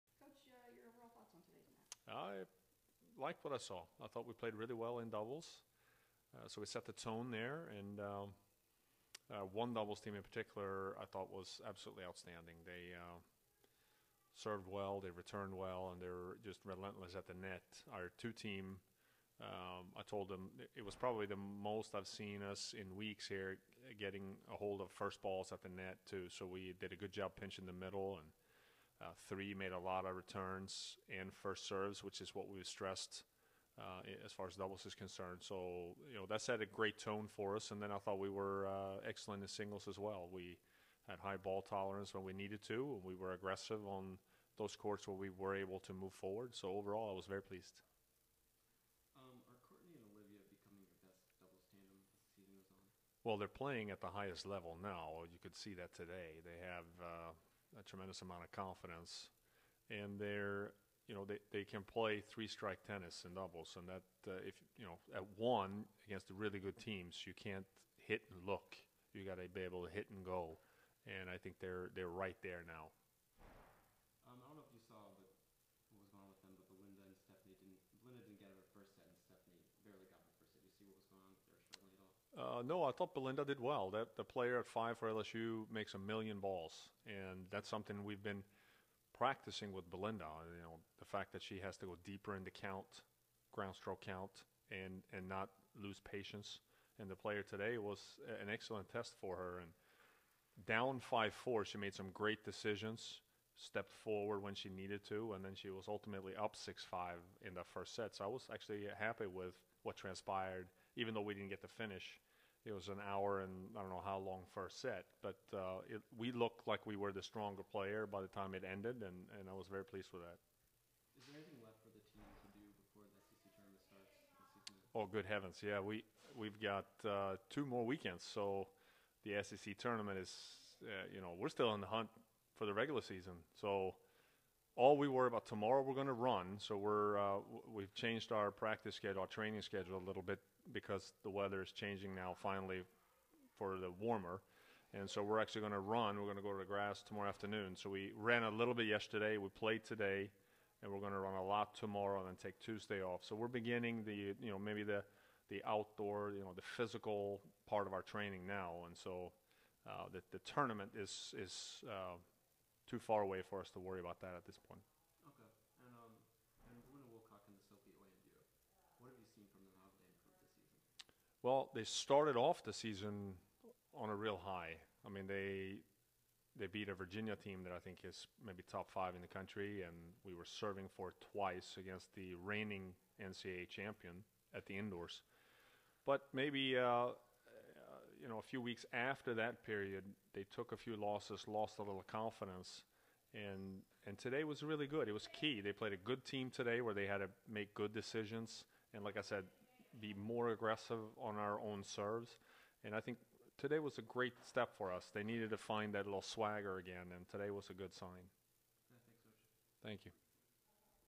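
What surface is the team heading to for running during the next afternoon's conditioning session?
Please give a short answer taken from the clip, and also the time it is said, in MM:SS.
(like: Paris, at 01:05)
Grass, at 02:26.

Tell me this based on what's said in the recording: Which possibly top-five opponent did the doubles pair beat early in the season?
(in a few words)
Virginia.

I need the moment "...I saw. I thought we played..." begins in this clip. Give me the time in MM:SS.
00:03.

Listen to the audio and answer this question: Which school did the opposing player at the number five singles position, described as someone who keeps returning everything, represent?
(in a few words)
LSU.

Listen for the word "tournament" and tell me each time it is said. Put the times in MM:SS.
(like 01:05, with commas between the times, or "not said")
02:03, 02:09, 02:40.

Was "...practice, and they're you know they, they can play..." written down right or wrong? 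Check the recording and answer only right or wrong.
wrong.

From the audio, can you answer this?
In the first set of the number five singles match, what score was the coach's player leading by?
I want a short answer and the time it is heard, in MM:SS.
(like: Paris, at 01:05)
6-5, at 01:46.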